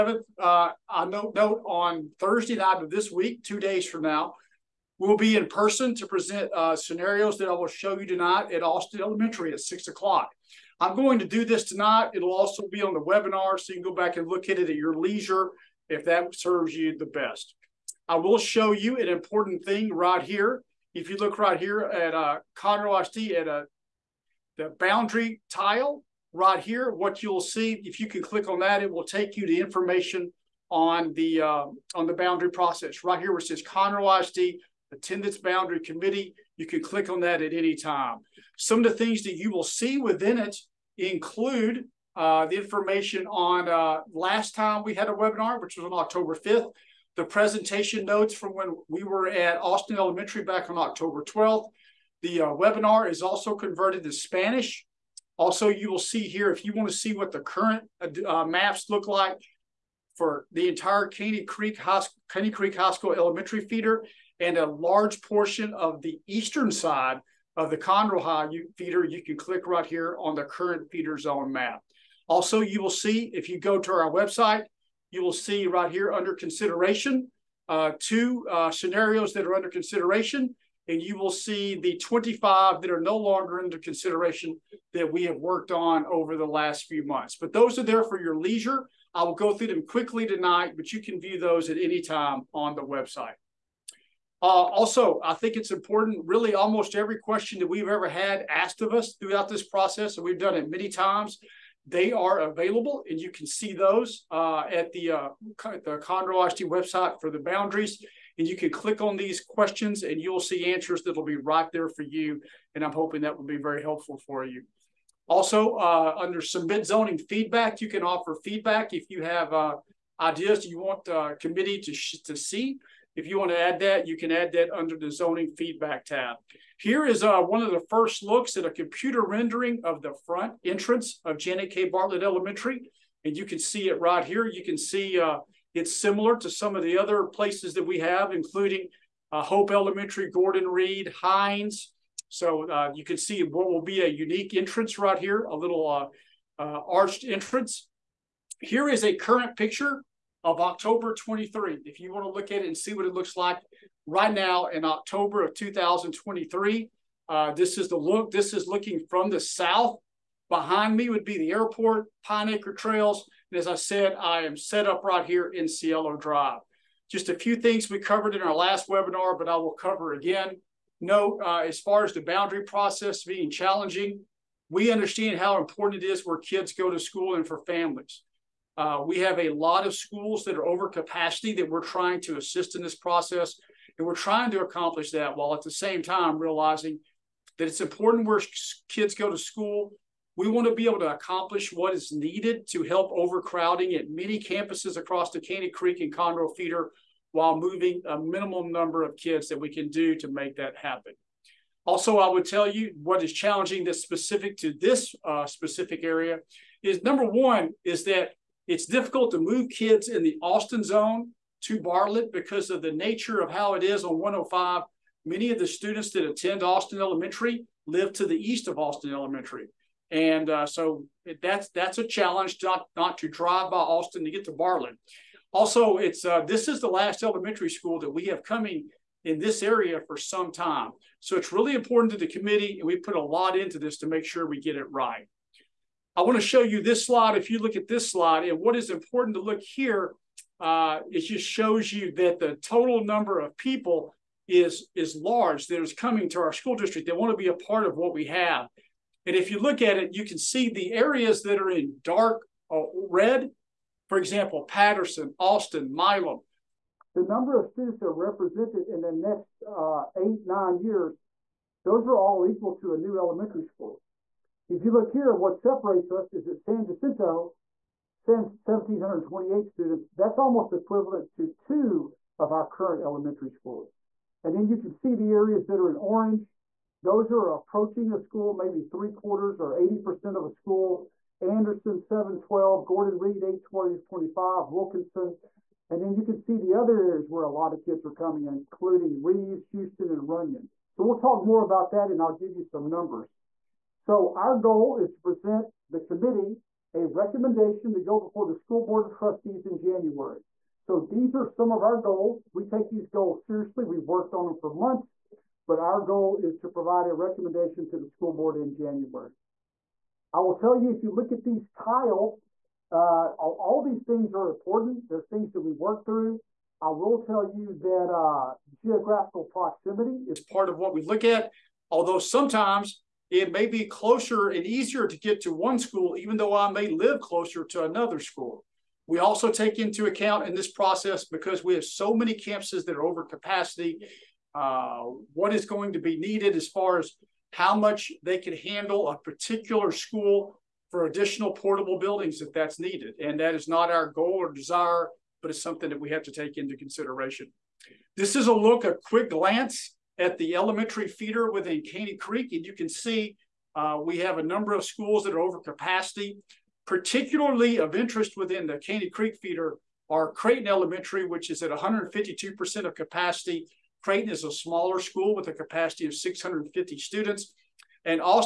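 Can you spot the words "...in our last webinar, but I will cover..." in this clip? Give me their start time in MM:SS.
02:48.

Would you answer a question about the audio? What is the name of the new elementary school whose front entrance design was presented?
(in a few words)
Janet K. Bartlett Elementary.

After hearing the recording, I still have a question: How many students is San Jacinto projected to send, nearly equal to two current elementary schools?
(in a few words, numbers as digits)
1,728.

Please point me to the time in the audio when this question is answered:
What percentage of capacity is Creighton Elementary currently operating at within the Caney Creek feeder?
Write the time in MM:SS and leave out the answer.
06:01.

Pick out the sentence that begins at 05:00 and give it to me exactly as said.
So these are some of our goals.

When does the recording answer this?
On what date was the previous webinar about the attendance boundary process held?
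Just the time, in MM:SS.
00:45.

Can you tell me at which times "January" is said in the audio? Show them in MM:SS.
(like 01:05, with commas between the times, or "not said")
04:59, 05:08.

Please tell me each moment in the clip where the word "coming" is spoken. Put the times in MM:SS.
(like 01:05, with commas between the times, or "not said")
03:48, 04:05, 04:48.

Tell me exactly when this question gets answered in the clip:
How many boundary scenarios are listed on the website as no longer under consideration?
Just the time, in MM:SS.
01:21.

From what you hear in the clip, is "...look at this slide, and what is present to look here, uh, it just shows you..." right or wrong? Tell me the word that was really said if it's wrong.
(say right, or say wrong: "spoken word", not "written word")
wrong: "important", not "present".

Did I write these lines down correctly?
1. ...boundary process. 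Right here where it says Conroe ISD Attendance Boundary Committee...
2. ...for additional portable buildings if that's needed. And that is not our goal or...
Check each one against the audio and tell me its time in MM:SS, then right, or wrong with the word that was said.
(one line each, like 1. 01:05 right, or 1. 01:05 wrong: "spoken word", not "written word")
1. 00:32 right
2. 05:40 right.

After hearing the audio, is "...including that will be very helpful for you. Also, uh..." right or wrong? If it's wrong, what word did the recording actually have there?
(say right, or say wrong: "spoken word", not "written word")
wrong: "hoping", not "including".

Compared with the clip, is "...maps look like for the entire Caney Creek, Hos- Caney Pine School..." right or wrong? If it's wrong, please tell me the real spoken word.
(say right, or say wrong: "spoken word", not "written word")
wrong: "Creek", not "Pine".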